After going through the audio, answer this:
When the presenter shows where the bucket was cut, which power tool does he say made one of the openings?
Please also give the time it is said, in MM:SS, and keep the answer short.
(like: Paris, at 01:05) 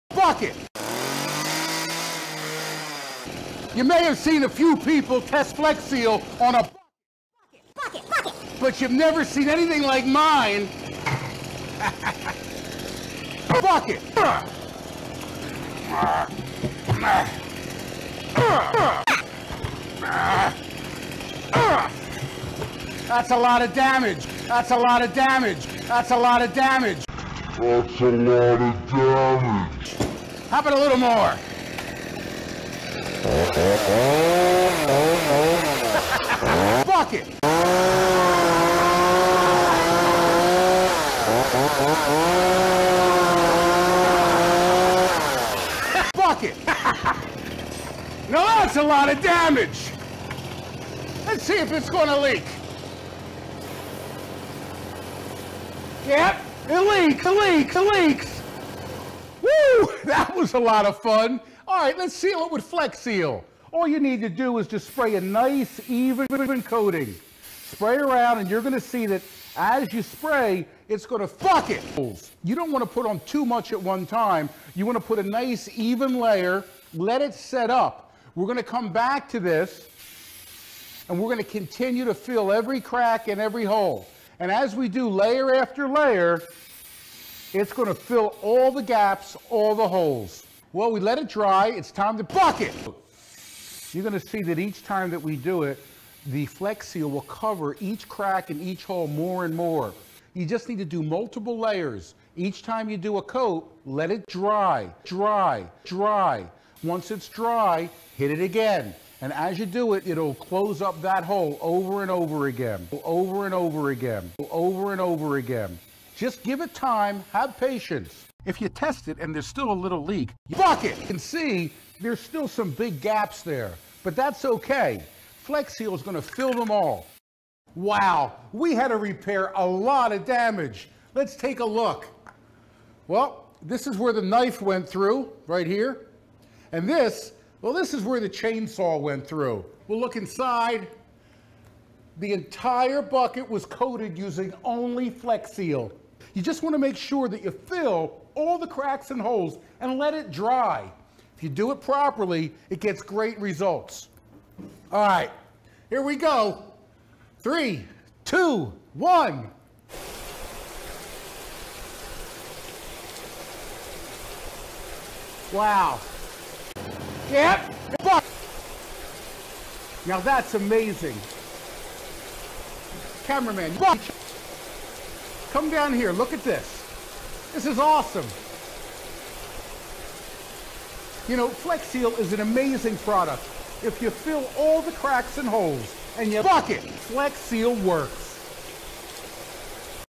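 chainsaw, at 02:18.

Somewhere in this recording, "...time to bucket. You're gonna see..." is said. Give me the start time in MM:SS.
01:31.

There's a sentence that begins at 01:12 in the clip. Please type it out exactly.
You don't want to put on too much at one time.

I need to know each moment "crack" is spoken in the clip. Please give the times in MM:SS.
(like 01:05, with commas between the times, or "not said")
01:22, 01:38, 02:28, 03:04.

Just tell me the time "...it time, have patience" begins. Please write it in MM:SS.
01:56.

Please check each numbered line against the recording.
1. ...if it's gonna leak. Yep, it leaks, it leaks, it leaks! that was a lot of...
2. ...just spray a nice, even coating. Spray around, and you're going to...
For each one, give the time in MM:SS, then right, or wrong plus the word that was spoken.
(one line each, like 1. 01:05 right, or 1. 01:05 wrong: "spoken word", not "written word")
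1. 00:51 right
2. 01:04 right.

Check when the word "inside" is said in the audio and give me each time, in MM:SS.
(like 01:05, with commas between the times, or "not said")
02:20.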